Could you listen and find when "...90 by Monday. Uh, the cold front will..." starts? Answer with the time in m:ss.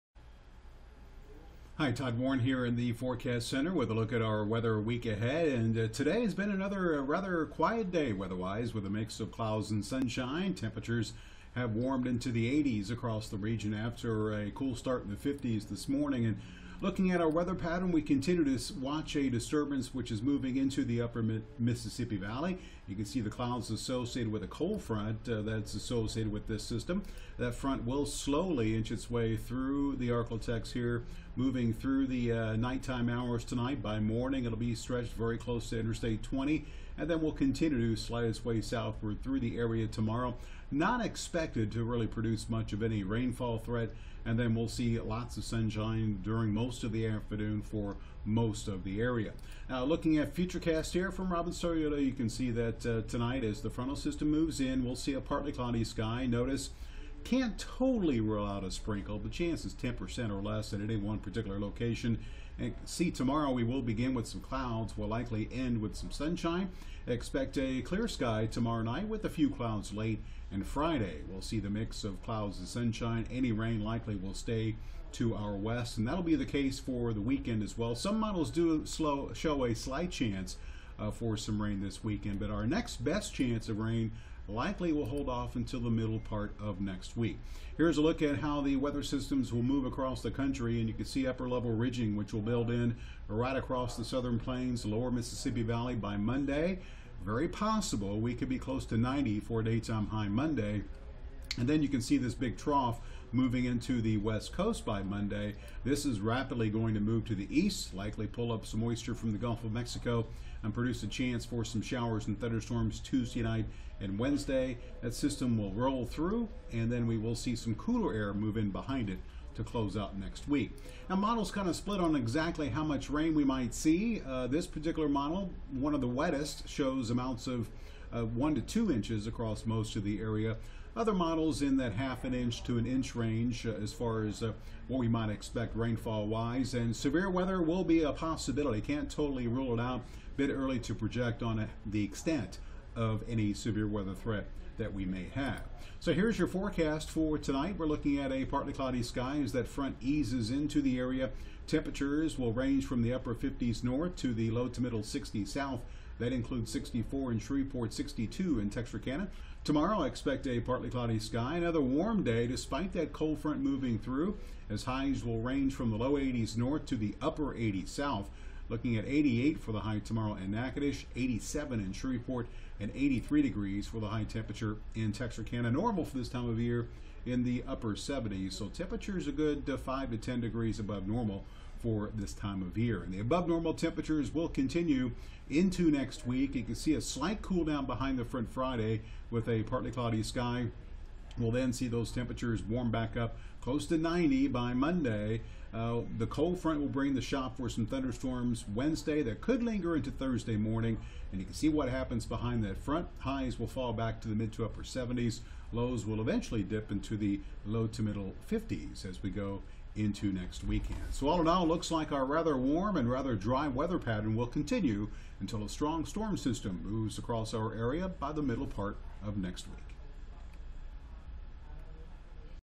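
3:13.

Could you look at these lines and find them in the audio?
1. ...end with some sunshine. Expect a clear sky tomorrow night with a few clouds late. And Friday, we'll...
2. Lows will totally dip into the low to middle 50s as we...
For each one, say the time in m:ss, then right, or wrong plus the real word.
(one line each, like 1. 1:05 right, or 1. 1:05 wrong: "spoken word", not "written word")
1. 1:05 right
2. 3:25 wrong: "eventually", not "totally".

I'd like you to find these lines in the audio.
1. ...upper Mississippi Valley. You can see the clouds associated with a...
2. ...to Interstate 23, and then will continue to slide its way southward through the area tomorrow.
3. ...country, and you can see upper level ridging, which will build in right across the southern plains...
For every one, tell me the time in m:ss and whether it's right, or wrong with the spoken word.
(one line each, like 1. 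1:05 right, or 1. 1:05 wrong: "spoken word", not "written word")
1. 0:20 right
2. 0:35 wrong: "20", not "23"
3. 1:30 right.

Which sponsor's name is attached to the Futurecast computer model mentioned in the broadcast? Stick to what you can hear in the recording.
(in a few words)
Robin Toyota.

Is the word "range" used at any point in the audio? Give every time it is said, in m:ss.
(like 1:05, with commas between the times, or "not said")
2:13, 2:32, 2:45.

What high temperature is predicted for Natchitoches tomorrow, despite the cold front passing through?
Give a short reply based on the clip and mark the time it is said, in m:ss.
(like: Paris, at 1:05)
88, at 2:49.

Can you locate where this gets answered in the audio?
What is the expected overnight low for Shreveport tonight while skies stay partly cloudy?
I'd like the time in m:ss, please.
2:36.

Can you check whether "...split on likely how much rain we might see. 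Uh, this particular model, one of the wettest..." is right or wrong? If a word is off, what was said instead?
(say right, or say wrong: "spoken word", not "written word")
wrong: "exactly", not "likely".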